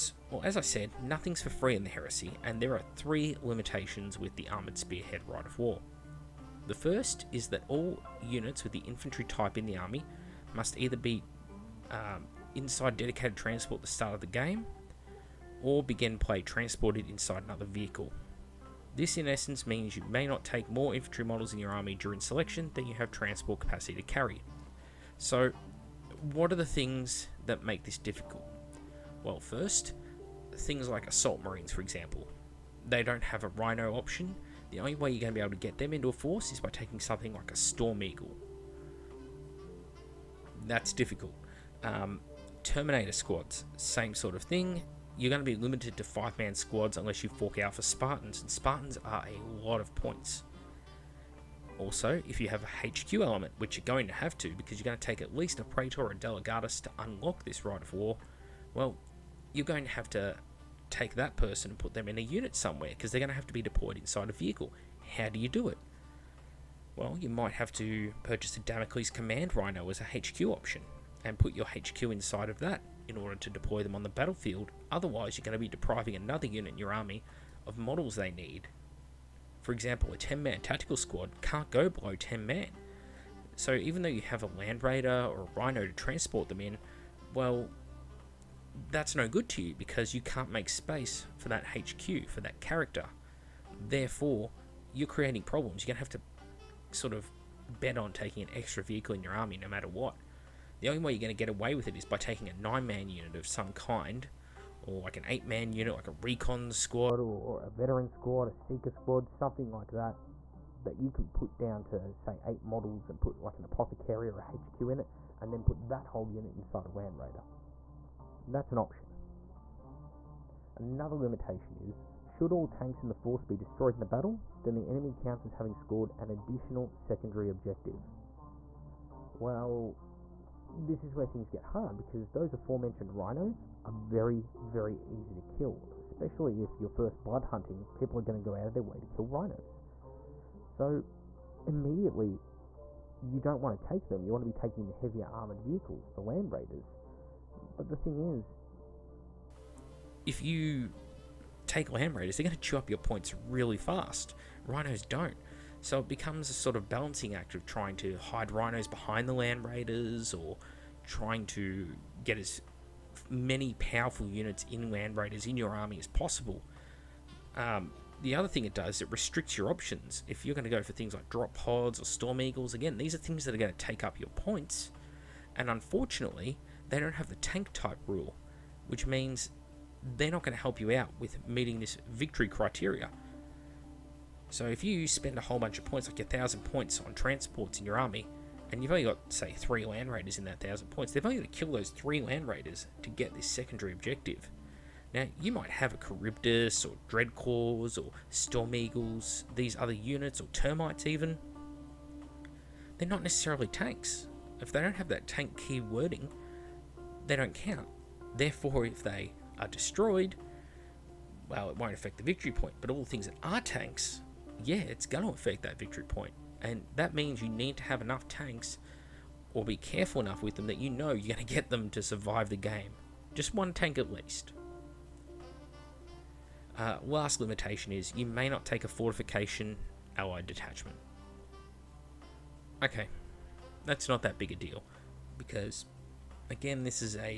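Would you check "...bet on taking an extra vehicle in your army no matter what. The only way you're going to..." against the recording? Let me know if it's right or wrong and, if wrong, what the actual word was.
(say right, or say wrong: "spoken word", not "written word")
right.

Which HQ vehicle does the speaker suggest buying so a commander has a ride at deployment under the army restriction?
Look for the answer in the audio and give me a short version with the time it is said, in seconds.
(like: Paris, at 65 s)
Damocles Command Rhino, at 68 s.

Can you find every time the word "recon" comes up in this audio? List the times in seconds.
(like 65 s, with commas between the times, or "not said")
106 s.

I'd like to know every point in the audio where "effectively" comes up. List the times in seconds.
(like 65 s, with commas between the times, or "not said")
not said.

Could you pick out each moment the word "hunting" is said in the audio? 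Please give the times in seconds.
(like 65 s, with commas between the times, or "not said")
137 s.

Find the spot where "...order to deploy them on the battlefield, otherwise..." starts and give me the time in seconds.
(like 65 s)
73 s.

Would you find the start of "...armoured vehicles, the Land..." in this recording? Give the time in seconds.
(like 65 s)
145 s.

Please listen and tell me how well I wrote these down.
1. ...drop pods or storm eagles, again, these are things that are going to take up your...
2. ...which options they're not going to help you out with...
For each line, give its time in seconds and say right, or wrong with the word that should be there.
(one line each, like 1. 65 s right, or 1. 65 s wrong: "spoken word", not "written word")
1. 171 s right
2. 178 s wrong: "means", not "options".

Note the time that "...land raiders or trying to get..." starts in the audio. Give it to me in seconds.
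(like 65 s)
159 s.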